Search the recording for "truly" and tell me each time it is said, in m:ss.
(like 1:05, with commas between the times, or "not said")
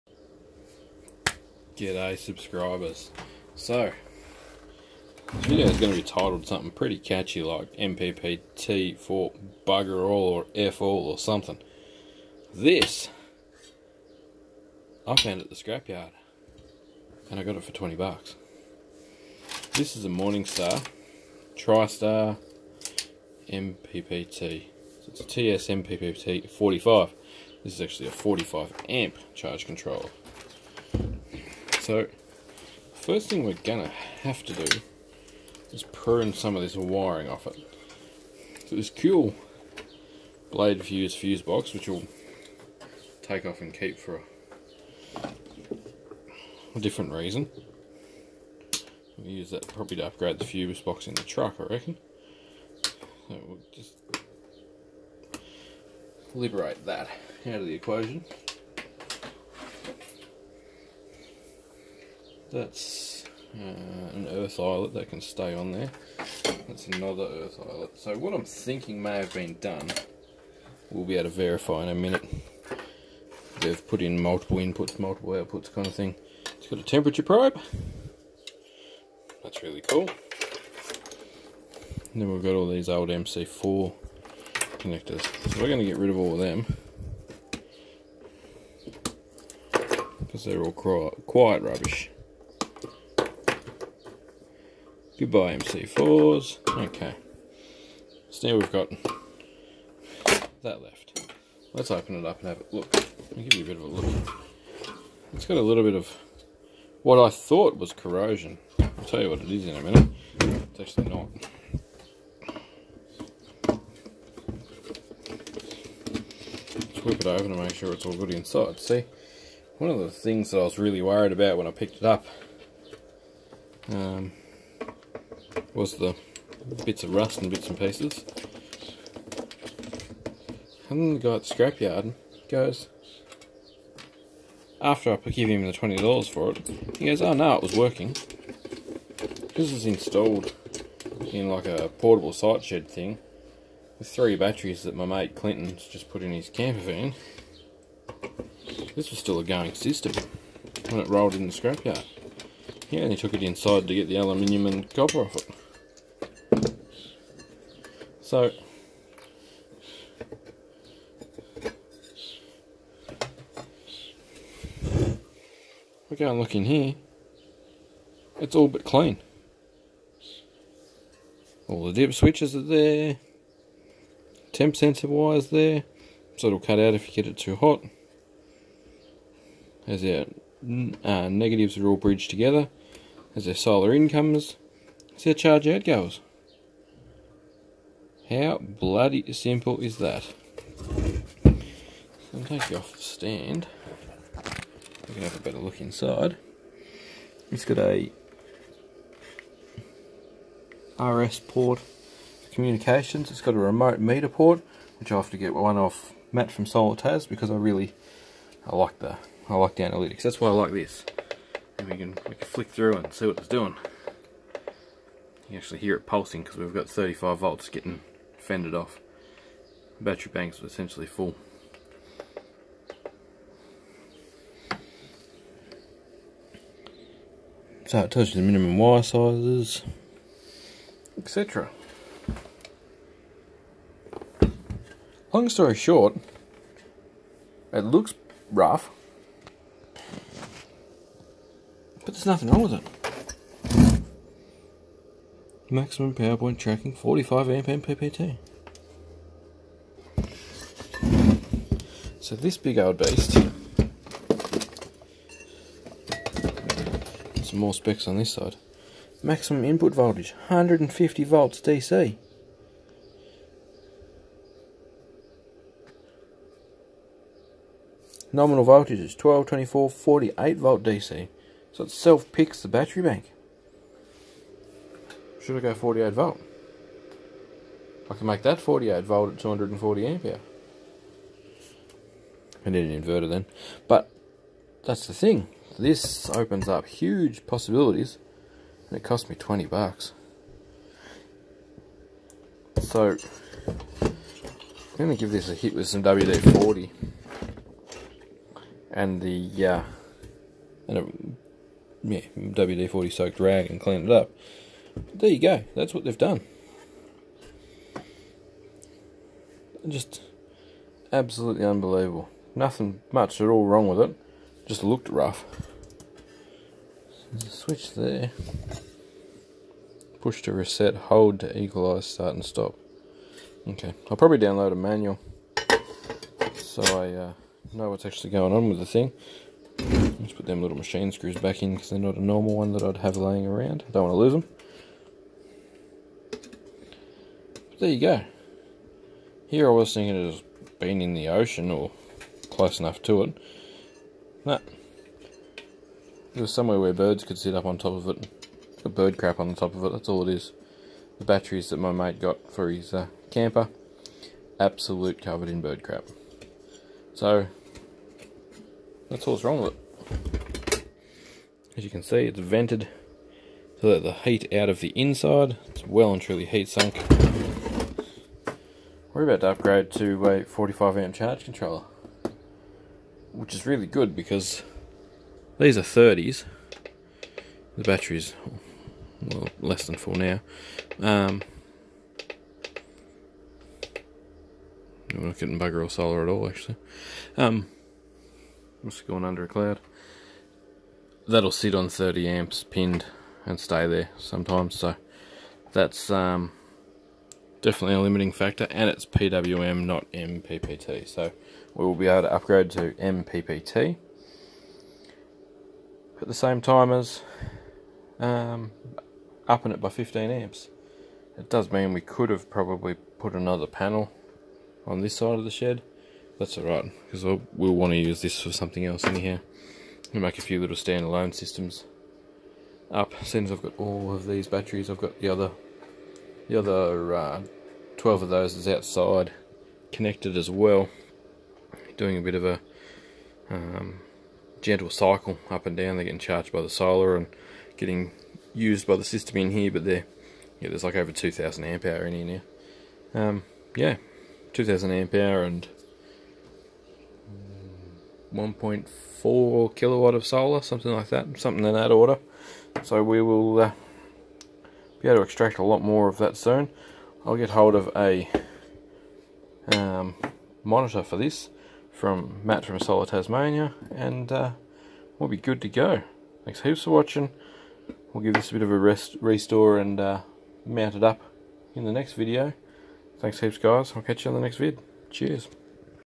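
6:06.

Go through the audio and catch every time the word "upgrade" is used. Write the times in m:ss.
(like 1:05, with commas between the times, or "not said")
0:50, 6:09, 6:42.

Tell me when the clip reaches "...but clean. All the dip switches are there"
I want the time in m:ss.
2:48.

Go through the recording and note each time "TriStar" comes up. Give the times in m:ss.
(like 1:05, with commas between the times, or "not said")
0:21.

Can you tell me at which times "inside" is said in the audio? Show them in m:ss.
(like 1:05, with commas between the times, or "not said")
1:58, 2:33, 3:15, 6:04.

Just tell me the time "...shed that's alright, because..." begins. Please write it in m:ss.
6:55.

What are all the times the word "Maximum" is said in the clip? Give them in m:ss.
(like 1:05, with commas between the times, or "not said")
4:05, 4:19.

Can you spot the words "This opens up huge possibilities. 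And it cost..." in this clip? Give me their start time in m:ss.
4:45.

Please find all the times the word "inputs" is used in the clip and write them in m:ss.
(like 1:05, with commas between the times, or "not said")
1:14, 4:19.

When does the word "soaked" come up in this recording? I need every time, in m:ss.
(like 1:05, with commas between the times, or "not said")
5:03.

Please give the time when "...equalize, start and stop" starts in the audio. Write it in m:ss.
5:21.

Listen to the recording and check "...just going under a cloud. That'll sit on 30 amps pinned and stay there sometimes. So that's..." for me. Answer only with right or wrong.
right.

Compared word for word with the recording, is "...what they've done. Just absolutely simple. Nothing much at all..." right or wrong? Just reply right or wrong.
wrong.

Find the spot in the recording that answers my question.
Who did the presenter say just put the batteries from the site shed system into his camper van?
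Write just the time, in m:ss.
2:25.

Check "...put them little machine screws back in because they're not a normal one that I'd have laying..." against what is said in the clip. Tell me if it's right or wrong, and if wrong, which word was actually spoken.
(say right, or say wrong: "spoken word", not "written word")
right.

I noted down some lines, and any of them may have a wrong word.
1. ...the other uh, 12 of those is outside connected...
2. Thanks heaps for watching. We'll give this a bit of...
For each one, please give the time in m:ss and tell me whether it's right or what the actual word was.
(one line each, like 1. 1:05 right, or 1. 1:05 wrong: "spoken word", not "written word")
1. 7:06 right
2. 7:46 right.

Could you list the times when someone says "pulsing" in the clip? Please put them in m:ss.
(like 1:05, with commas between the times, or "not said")
3:36.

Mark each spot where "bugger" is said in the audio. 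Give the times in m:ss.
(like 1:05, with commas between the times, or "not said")
0:09, 6:25.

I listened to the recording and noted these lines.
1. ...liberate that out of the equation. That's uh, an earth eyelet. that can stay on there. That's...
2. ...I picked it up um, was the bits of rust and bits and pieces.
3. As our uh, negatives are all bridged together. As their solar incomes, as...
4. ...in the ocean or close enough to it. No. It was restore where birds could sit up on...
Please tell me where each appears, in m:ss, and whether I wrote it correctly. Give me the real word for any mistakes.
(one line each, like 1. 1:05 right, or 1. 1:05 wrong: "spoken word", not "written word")
1. 0:56 right
2. 2:01 right
3. 2:59 right
4. 5:41 wrong: "somewhere", not "restore".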